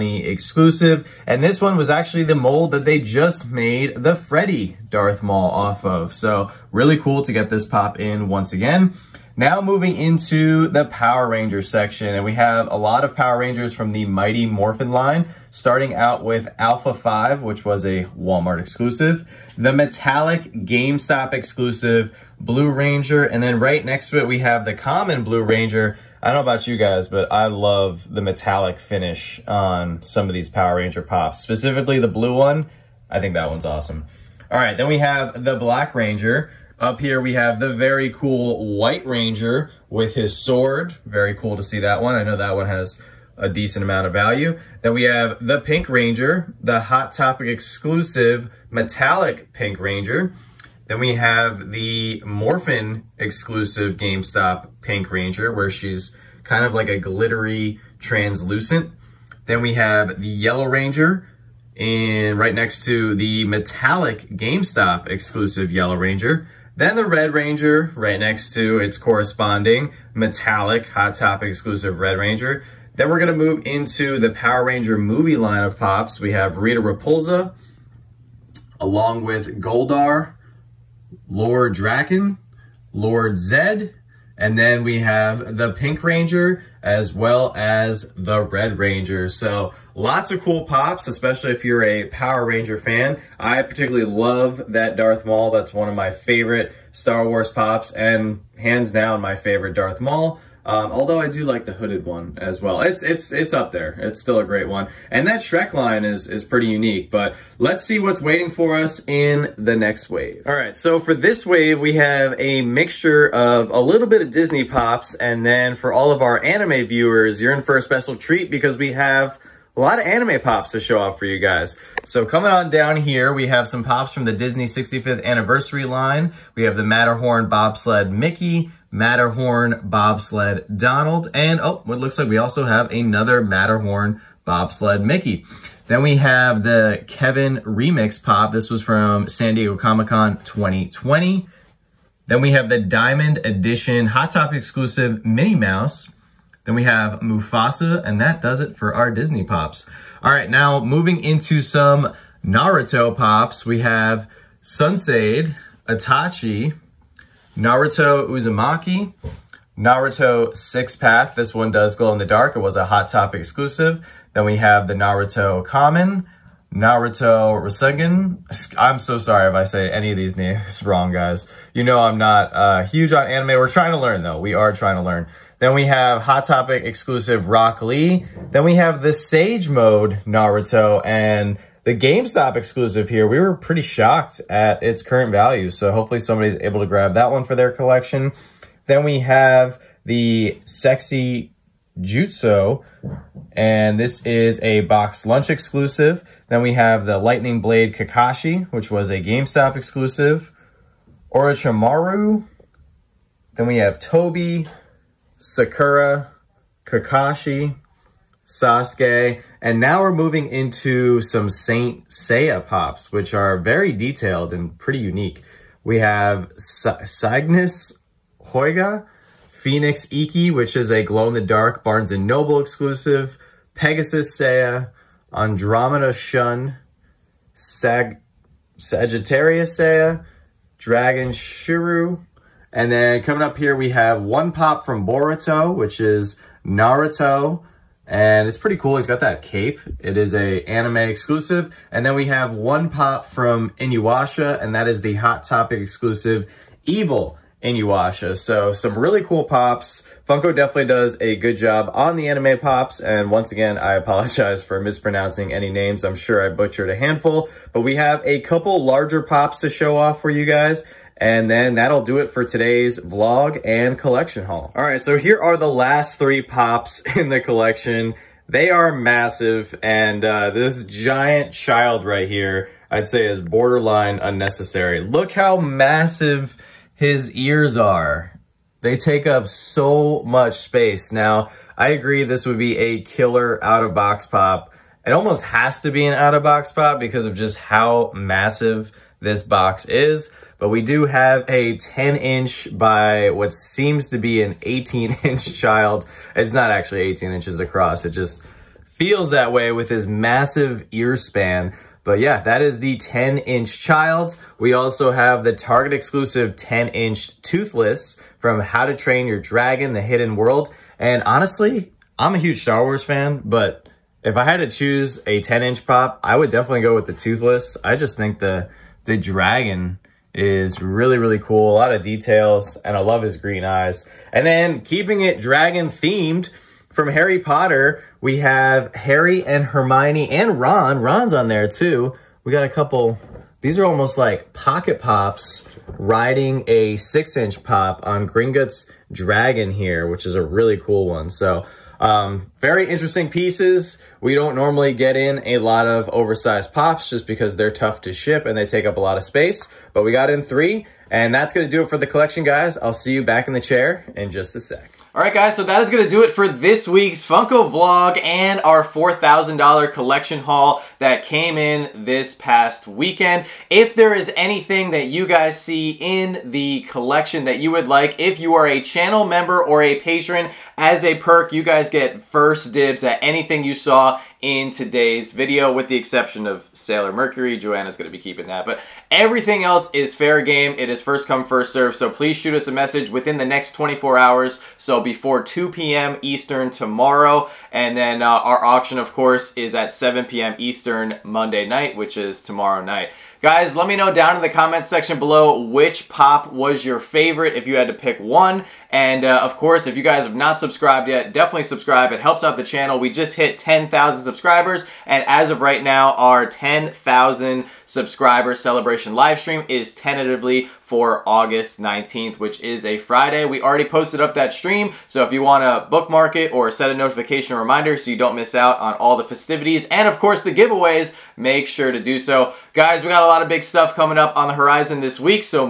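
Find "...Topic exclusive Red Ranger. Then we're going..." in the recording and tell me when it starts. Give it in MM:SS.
01:11.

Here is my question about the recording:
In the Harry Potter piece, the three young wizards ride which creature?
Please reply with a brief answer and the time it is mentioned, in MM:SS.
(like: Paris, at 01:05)
Gringotts Dragon, at 05:38.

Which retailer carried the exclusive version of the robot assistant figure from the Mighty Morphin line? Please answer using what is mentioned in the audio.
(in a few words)
Walmart.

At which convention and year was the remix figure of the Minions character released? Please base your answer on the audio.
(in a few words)
San Diego Comic Con 2020.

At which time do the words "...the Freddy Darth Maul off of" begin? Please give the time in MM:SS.
00:03.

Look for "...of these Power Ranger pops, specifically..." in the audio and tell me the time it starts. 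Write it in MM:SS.
00:30.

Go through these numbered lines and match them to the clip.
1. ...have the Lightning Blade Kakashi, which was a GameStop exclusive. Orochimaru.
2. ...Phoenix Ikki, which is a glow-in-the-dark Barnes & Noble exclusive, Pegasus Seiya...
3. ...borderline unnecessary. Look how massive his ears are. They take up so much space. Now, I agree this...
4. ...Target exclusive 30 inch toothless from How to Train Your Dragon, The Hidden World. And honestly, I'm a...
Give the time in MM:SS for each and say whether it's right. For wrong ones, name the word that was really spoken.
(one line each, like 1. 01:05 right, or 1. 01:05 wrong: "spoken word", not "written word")
1. 03:16 right
2. 03:39 right
3. 04:33 right
4. 05:05 wrong: "10", not "30".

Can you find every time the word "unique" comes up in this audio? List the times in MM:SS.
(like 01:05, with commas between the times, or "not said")
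01:46, 03:34.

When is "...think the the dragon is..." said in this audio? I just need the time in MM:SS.
05:18.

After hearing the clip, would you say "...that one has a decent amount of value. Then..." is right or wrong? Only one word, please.
right.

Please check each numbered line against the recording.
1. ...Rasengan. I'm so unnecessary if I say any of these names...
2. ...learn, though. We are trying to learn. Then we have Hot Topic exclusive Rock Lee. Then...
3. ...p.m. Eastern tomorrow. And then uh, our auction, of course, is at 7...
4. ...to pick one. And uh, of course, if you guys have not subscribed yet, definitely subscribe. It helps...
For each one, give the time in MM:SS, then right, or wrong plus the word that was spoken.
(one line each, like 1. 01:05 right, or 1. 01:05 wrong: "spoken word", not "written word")
1. 02:47 wrong: "sorry", not "unnecessary"
2. 02:53 right
3. 06:25 right
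4. 06:37 right.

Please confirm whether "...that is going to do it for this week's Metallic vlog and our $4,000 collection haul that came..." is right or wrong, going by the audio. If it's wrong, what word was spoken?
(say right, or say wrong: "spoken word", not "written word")
wrong: "Funko", not "Metallic".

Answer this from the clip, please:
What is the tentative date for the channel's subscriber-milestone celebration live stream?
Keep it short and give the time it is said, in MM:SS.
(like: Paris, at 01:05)
August 19th, at 06:51.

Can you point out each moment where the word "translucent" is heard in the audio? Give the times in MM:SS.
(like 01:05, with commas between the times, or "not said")
00:57.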